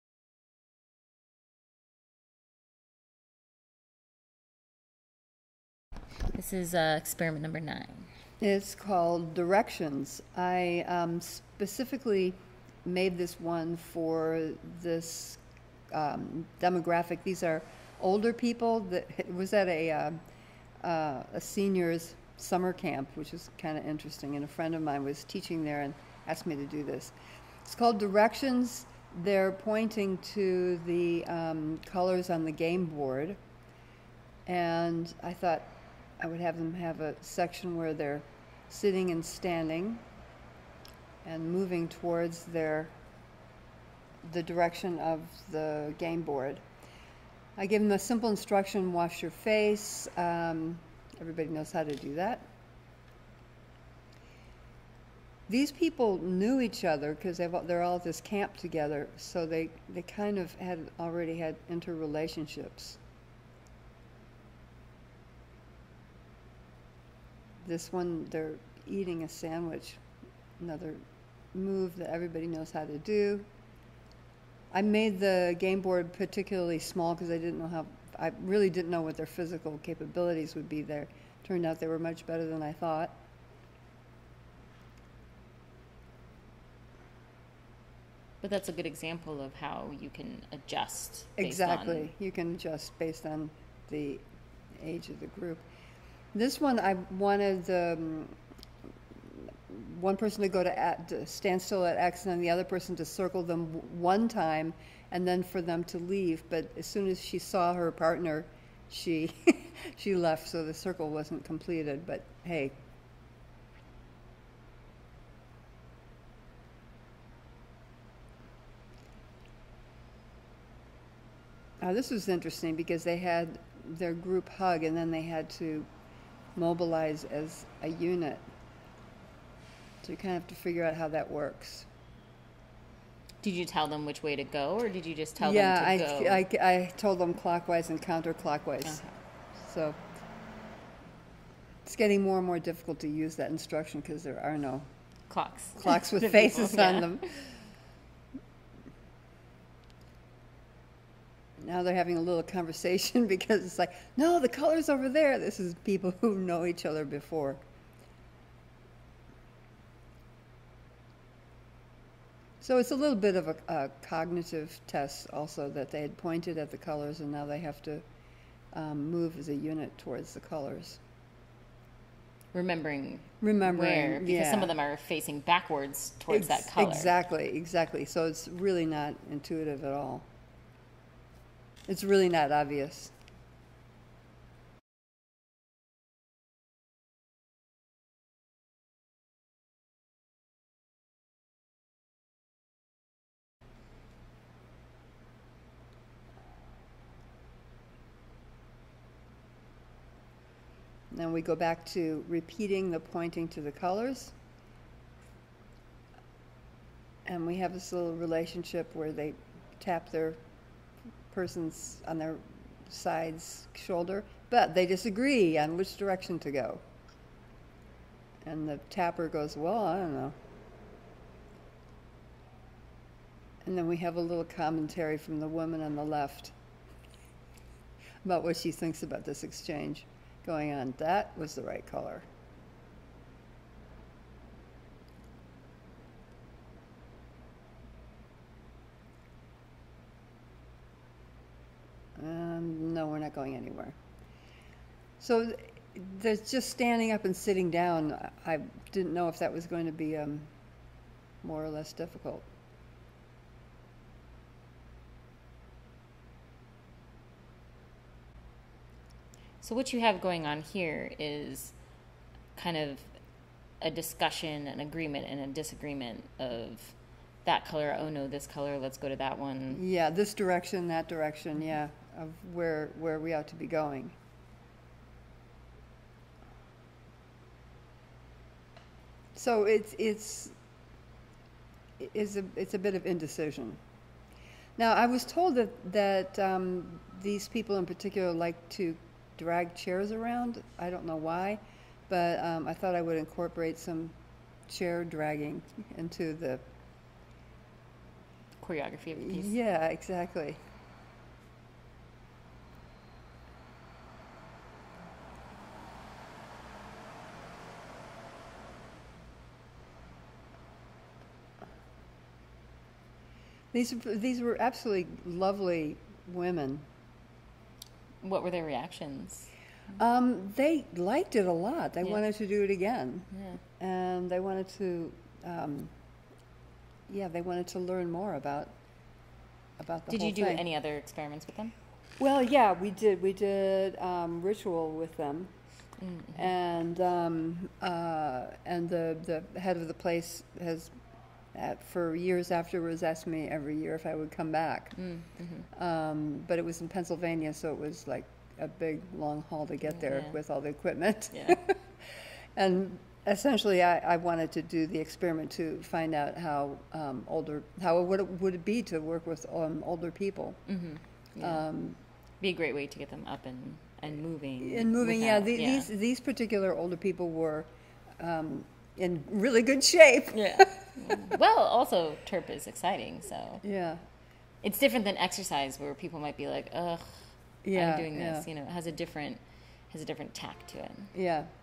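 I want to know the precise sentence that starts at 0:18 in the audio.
That it was at a uh, uh, a seniors summer camp, which is kind of interesting.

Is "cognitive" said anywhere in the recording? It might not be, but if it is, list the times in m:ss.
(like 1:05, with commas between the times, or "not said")
2:44.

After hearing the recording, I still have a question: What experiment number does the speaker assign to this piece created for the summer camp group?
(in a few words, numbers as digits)
Nine.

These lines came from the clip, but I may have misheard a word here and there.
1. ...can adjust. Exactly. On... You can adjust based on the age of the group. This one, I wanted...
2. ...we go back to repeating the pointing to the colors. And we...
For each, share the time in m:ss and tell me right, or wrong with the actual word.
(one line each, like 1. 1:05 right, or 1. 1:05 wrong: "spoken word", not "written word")
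1. 1:30 right
2. 3:21 right.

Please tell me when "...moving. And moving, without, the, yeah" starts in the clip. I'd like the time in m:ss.
6:04.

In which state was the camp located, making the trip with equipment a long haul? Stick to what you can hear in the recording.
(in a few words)
Pennsylvania.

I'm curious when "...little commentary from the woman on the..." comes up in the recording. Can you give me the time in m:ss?
3:44.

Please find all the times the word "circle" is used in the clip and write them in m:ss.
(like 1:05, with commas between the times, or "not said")
1:43, 1:50.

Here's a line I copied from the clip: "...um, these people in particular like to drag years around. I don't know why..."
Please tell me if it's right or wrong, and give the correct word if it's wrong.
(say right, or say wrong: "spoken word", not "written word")
wrong: "chairs", not "years".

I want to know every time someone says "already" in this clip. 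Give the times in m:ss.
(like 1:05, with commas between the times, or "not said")
1:00.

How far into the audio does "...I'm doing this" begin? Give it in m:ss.
6:17.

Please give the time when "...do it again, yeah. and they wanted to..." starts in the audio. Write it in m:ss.
5:22.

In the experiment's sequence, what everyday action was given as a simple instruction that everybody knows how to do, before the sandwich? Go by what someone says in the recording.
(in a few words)
Wash your face.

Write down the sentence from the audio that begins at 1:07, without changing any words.
this one, they're eating a sandwich, another move that everybody knows how to do.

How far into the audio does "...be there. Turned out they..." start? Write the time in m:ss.
1:20.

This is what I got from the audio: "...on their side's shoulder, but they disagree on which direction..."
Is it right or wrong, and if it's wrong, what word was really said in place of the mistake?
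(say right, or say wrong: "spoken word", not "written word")
right.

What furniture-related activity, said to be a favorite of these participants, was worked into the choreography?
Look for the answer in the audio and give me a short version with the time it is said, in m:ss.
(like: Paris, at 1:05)
Chair dragging, at 4:54.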